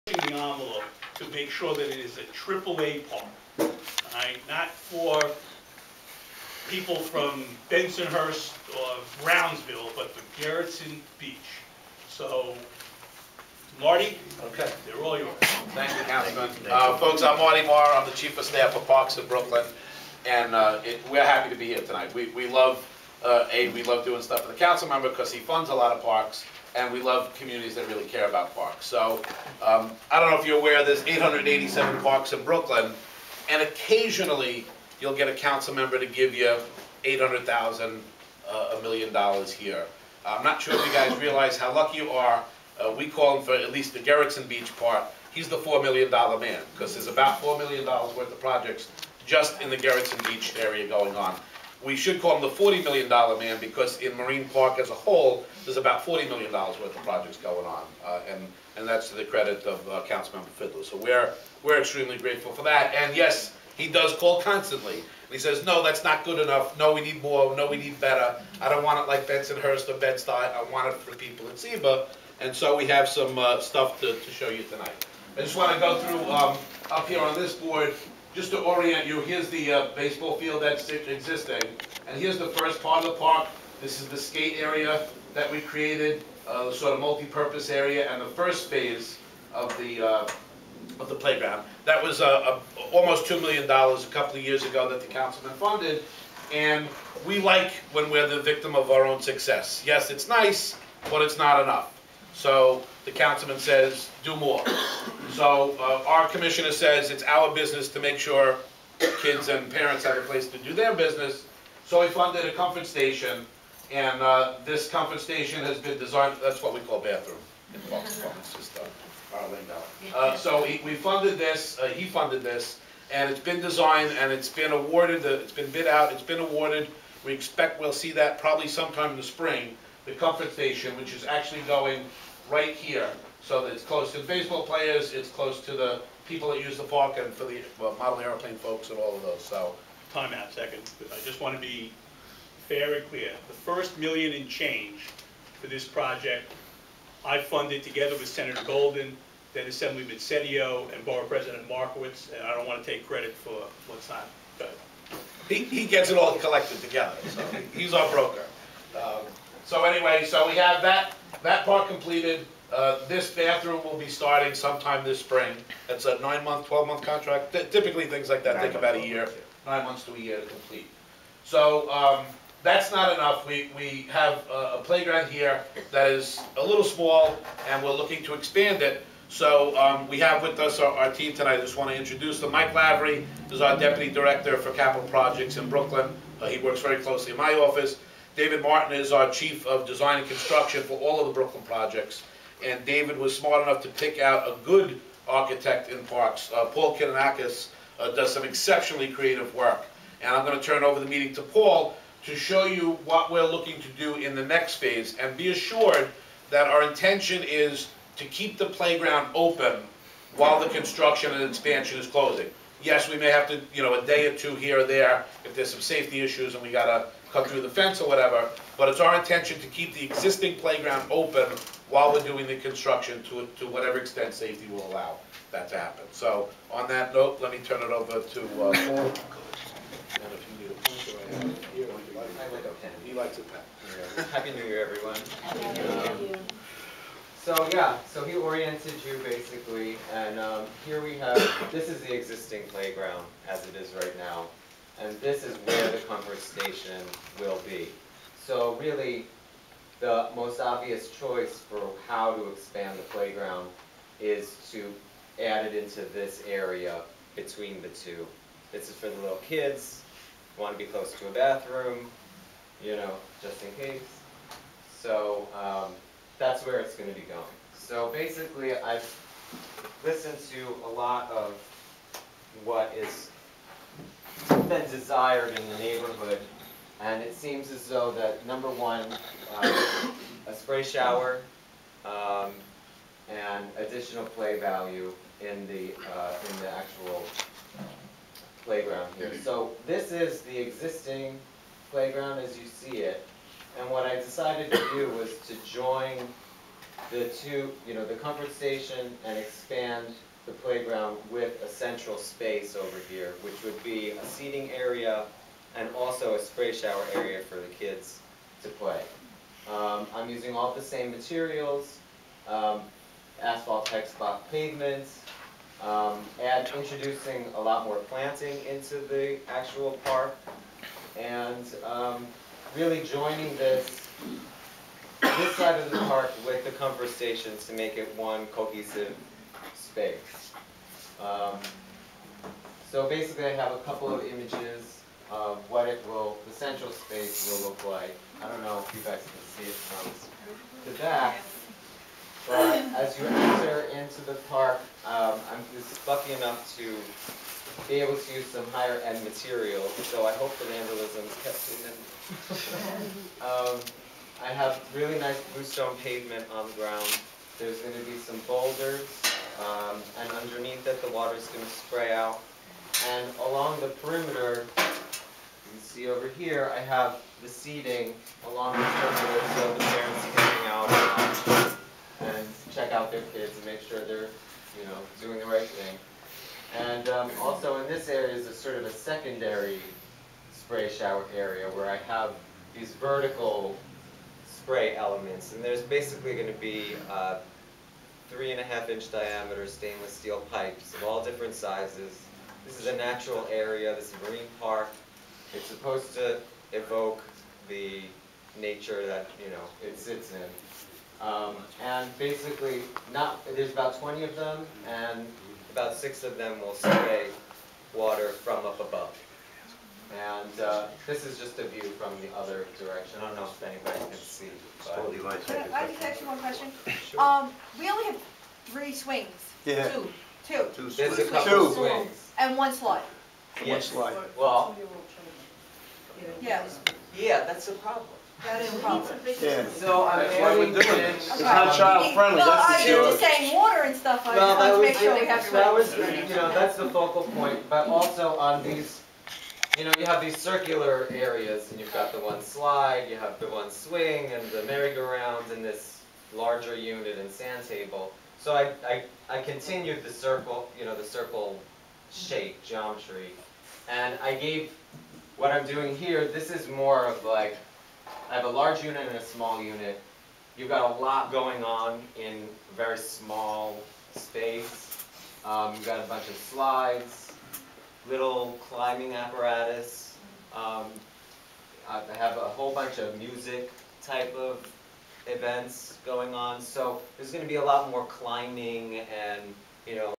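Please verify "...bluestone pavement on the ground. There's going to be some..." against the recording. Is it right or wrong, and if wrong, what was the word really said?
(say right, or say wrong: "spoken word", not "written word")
right.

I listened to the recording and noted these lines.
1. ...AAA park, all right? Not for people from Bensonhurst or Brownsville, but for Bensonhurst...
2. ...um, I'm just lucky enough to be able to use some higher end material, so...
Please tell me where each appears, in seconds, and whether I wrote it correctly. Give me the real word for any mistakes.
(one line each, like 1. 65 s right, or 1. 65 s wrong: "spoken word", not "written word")
1. 2 s wrong: "Gerritsen", not "Bensonhurst"
2. 345 s right.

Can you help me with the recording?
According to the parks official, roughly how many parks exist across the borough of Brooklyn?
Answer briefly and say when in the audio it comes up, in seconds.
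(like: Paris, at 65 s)
887, at 31 s.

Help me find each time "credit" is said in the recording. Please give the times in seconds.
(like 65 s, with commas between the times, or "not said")
59 s, 153 s.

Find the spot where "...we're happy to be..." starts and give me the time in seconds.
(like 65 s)
21 s.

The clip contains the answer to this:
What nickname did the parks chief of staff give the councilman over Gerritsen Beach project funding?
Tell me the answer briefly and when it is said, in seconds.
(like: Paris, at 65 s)
The $4 million man, at 45 s.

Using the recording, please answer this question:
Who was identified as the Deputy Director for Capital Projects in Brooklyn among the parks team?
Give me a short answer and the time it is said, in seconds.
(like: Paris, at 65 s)
Mike Lavery, at 182 s.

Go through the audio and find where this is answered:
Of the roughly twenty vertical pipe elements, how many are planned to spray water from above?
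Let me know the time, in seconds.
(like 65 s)
405 s.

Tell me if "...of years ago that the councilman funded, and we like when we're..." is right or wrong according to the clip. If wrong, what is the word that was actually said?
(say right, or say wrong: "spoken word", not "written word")
right.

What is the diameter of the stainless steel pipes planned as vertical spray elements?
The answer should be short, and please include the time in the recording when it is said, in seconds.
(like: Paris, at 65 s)
3.5 inches, at 388 s.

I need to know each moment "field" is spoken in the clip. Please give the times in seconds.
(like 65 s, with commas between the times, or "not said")
80 s.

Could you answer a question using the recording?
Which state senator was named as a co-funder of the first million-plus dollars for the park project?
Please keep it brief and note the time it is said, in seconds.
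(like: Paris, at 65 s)
Senator Golden, at 148 s.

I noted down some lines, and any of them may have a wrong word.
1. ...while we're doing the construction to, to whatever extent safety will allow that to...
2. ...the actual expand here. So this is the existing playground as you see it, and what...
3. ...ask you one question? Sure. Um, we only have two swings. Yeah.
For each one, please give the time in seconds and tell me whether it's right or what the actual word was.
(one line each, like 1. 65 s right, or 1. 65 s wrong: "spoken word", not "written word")
1. 221 s right
2. 286 s wrong: "playground", not "expand"
3. 416 s wrong: "three", not "two".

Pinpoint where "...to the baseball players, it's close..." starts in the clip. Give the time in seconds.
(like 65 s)
134 s.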